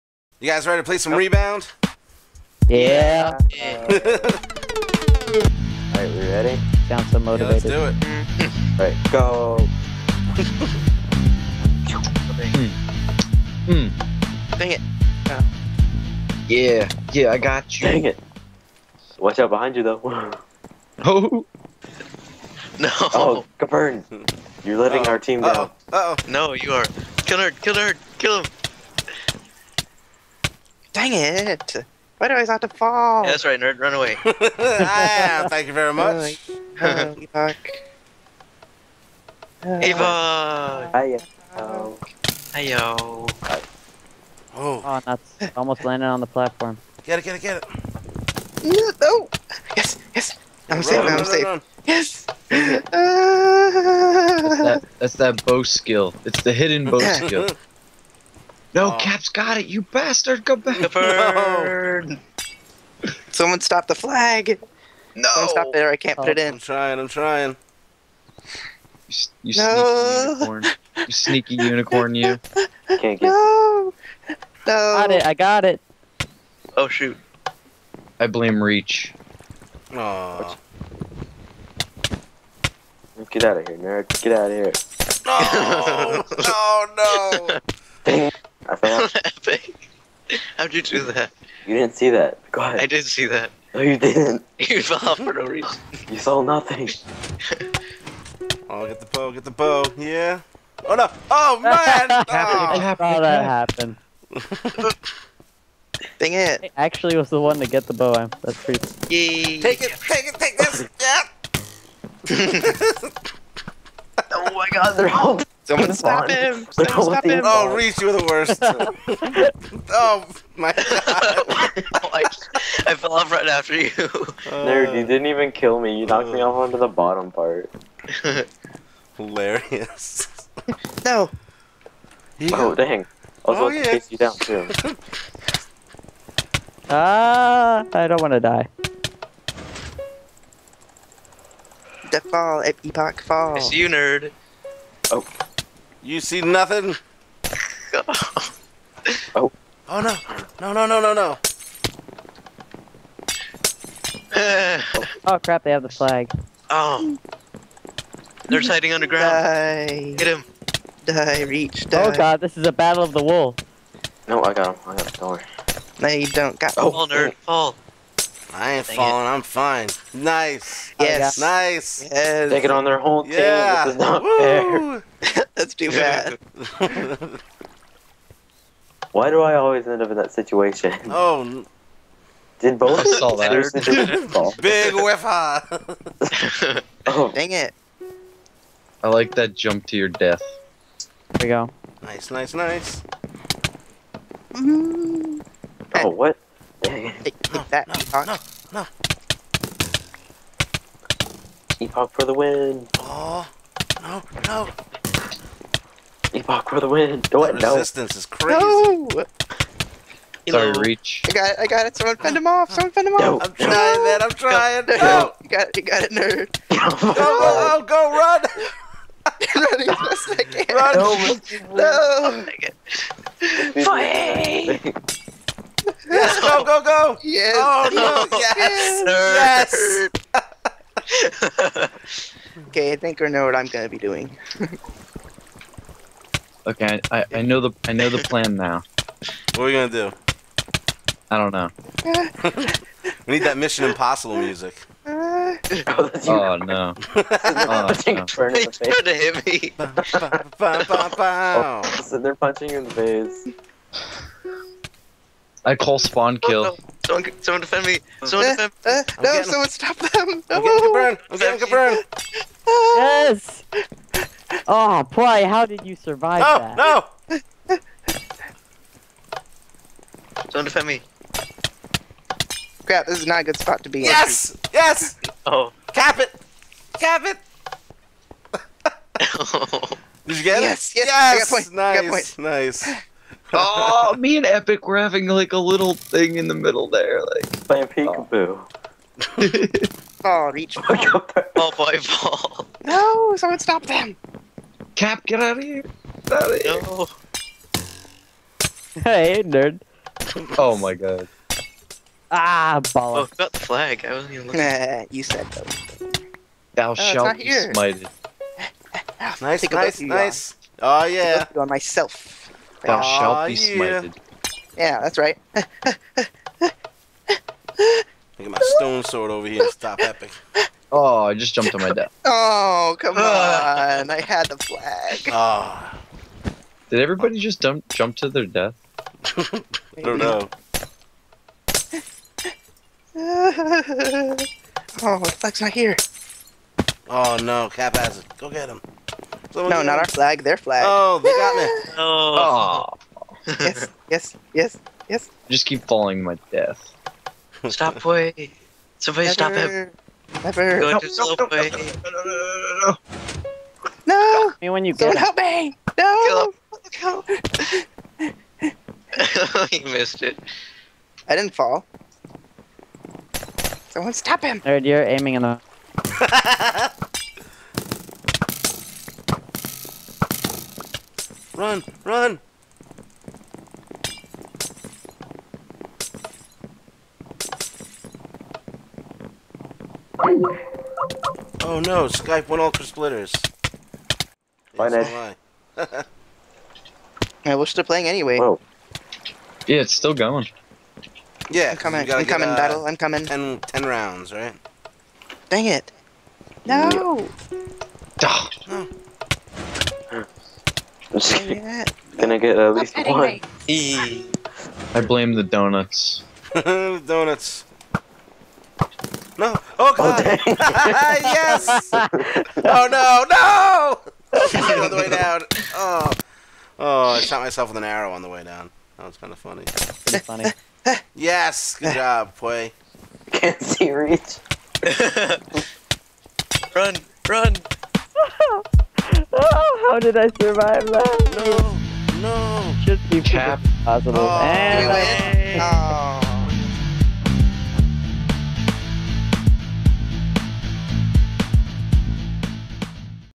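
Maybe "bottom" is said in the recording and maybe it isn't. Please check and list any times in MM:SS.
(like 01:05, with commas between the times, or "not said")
02:06.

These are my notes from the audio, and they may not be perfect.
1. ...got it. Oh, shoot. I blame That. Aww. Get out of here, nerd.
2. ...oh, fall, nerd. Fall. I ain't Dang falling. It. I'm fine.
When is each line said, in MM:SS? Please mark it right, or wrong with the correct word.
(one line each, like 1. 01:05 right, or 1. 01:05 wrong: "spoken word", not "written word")
1. 01:15 wrong: "Reach", not "That"
2. 02:46 right.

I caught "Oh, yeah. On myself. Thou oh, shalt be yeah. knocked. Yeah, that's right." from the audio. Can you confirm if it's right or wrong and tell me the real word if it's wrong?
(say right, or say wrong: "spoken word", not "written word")
wrong: "smited", not "knocked".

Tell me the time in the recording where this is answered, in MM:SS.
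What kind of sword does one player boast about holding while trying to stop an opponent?
05:18.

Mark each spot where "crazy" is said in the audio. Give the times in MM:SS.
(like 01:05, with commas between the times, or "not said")
03:28.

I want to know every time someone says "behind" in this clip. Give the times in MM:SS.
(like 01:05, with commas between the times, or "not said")
00:19.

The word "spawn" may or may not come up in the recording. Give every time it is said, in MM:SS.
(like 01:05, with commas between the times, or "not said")
04:15.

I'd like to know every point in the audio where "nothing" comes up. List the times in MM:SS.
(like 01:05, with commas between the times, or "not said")
01:36, 02:26.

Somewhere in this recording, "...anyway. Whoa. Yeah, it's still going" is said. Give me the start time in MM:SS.
06:28.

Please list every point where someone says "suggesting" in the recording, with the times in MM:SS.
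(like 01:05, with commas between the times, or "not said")
not said.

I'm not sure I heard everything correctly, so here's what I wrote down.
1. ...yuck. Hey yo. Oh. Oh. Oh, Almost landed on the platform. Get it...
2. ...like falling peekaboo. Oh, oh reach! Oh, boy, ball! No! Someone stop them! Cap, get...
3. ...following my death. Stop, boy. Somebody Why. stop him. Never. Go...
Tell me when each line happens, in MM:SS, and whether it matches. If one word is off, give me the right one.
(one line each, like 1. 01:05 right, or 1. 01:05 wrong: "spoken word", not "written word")
1. 00:39 right
2. 04:47 wrong: "playing", not "falling"
3. 05:45 wrong: "Never", not "Why".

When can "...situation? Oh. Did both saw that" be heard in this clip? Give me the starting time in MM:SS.
03:00.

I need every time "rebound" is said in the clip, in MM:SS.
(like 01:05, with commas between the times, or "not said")
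00:01.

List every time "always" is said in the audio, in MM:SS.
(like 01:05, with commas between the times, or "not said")
02:59.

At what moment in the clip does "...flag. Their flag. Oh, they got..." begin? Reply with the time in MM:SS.
05:40.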